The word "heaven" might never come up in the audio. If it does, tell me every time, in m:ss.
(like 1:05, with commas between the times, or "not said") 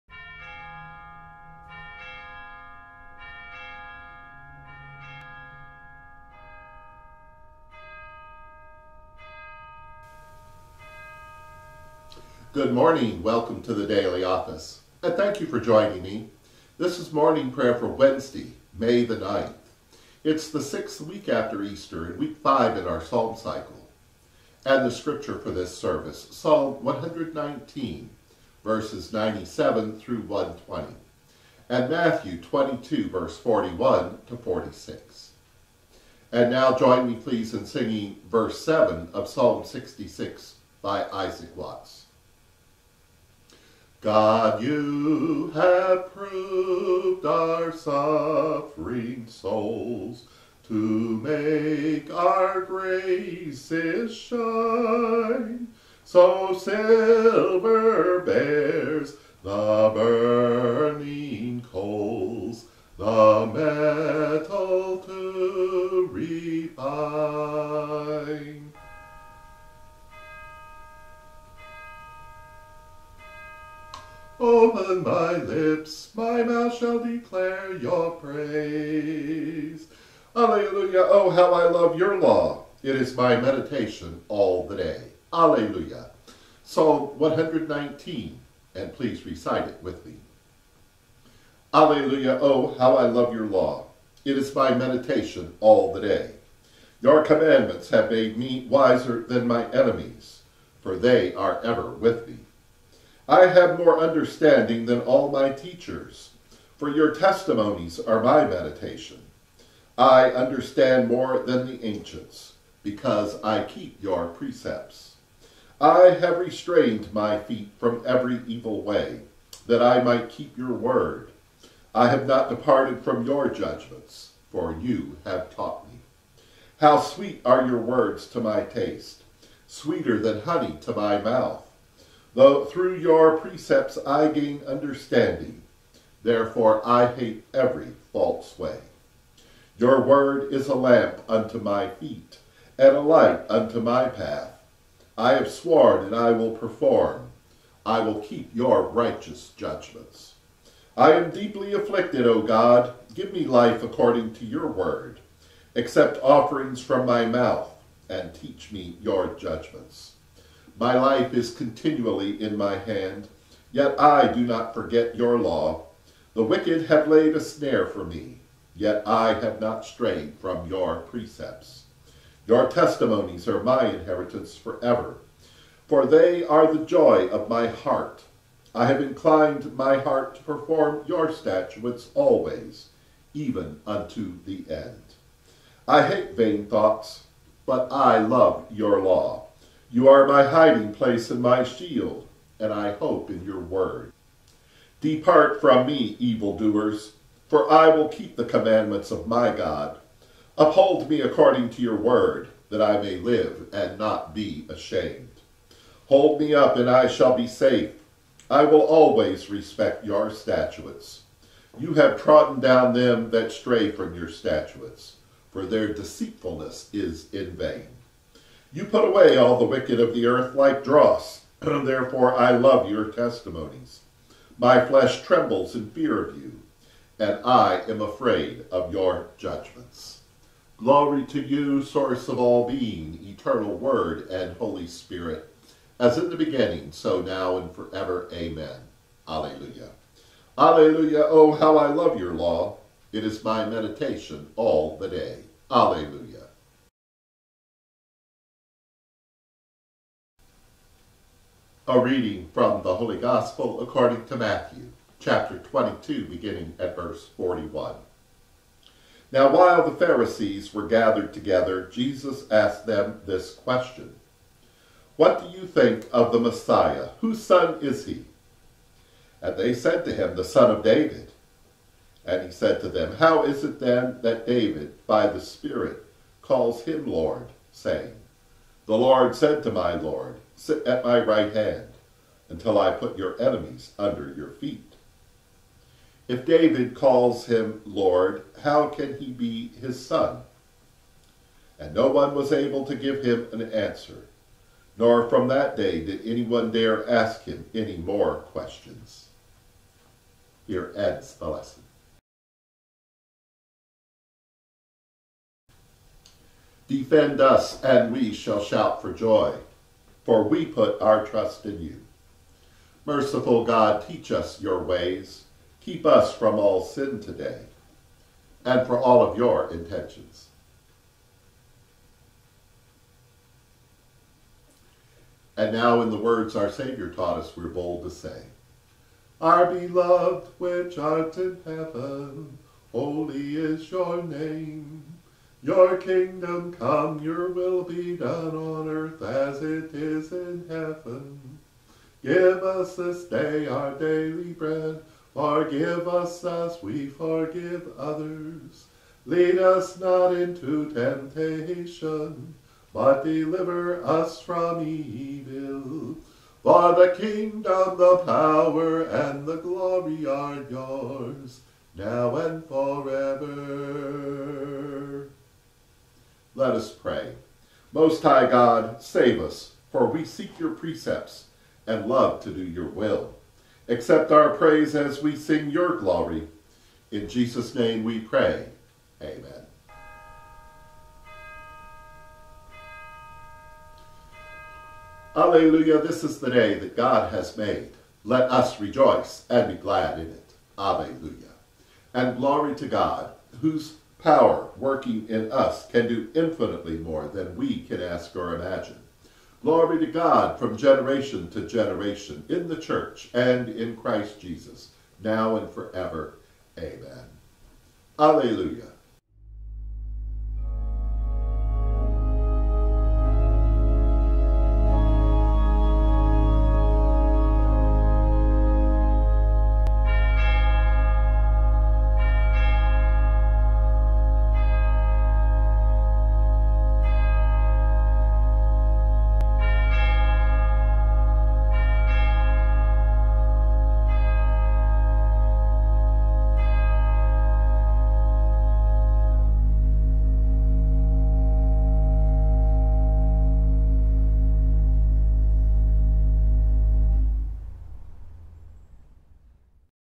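5:31, 5:40.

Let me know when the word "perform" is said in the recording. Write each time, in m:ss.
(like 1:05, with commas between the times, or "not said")
2:26, 3:00.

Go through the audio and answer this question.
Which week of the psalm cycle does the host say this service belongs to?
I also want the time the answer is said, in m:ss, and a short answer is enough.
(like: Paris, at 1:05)
week five, at 0:22.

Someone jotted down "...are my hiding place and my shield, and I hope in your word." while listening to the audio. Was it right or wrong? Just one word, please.
right.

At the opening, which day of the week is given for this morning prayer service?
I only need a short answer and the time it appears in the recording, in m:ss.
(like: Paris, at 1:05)
Wednesday, at 0:17.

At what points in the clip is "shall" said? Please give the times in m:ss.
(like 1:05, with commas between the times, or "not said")
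1:16, 3:27, 5:08.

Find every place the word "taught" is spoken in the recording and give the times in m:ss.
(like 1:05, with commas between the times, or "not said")
2:05, 5:27.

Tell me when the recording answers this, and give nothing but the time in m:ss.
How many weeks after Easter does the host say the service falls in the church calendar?
0:20.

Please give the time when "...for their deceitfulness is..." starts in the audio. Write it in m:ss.
3:35.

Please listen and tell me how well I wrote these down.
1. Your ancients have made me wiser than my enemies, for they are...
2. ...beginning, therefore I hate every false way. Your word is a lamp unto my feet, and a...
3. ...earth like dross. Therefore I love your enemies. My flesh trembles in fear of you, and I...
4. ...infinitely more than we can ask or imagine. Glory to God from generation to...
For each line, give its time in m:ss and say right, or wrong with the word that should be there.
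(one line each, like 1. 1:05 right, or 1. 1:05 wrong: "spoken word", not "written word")
1. 1:37 wrong: "commandments", not "ancients"
2. 2:14 wrong: "understanding", not "beginning"
3. 3:40 wrong: "testimonies", not "enemies"
4. 6:36 right.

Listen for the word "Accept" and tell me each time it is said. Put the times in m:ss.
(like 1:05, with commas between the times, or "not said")
2:35, 6:13.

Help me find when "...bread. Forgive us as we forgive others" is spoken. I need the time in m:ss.
5:44.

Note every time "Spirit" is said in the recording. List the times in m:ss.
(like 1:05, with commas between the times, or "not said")
3:54, 4:35.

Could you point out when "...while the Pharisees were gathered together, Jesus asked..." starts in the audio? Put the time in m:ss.
4:19.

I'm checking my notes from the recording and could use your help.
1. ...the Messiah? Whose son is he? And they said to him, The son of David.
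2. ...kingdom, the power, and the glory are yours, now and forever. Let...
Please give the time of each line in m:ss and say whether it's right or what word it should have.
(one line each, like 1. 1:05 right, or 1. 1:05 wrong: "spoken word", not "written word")
1. 4:26 right
2. 5:57 right.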